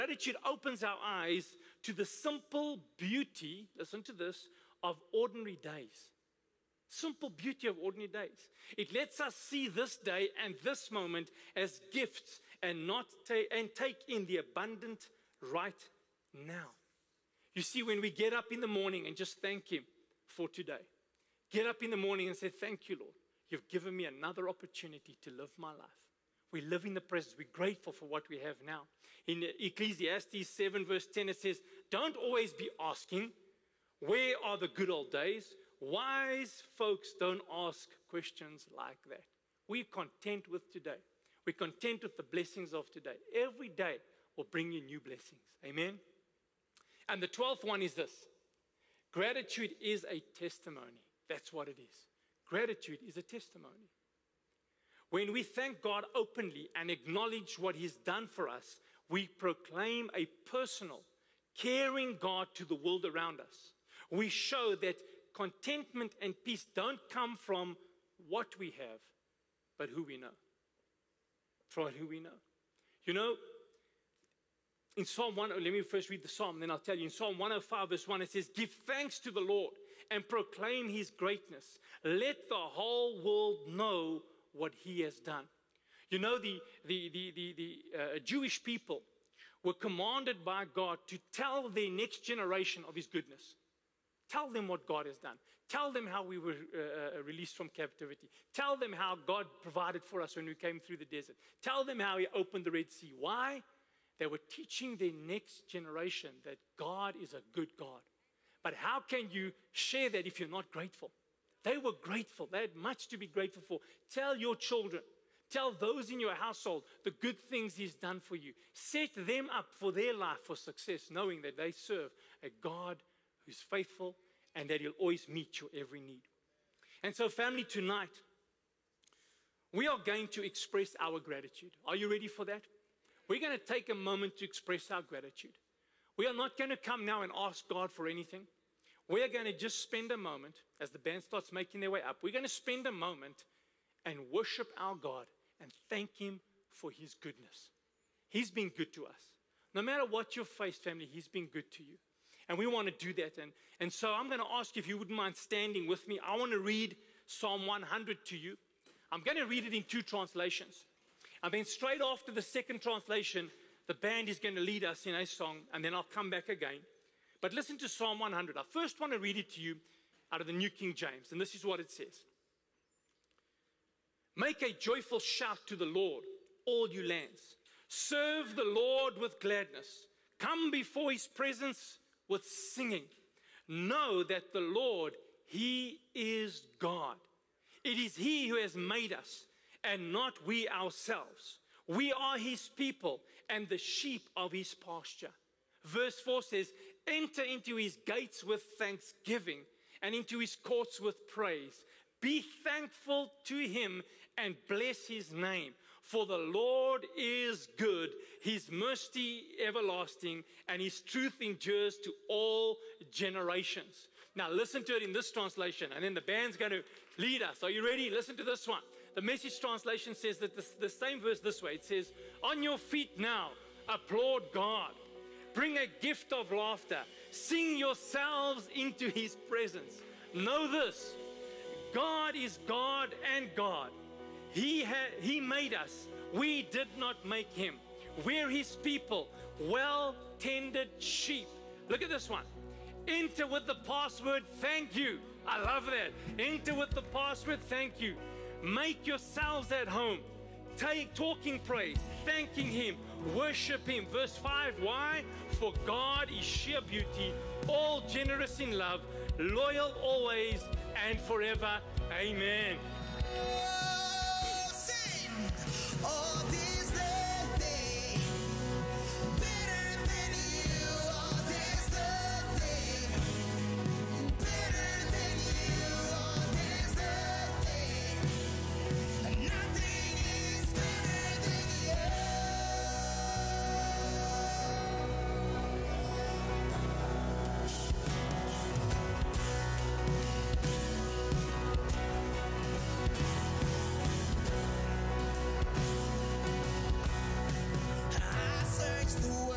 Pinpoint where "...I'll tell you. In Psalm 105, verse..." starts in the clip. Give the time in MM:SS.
01:16.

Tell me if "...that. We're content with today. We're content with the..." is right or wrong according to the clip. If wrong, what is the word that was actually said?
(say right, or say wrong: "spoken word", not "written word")
right.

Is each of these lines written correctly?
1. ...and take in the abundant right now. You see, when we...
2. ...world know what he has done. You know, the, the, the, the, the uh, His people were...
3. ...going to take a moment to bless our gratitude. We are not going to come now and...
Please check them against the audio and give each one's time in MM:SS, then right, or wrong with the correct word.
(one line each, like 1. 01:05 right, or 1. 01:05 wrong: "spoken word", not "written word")
1. 00:13 right
2. 01:23 wrong: "Jewish", not "His"
3. 02:13 wrong: "express", not "bless".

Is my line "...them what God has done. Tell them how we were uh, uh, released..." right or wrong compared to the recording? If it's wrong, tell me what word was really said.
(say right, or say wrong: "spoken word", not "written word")
right.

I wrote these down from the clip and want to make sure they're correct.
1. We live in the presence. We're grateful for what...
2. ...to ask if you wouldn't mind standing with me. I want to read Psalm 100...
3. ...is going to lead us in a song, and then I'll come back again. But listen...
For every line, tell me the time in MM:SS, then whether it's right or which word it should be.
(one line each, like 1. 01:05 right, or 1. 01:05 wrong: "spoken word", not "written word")
1. 00:26 right
2. 02:34 right
3. 02:44 right.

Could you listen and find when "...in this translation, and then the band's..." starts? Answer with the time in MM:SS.
03:35.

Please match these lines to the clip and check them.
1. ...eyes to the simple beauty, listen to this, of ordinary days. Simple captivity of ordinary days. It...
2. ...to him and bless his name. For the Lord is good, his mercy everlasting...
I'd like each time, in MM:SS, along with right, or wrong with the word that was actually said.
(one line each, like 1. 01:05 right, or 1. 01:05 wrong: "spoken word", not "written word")
1. 00:00 wrong: "beauty", not "captivity"
2. 03:23 right.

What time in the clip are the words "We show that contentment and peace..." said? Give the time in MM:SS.
01:04.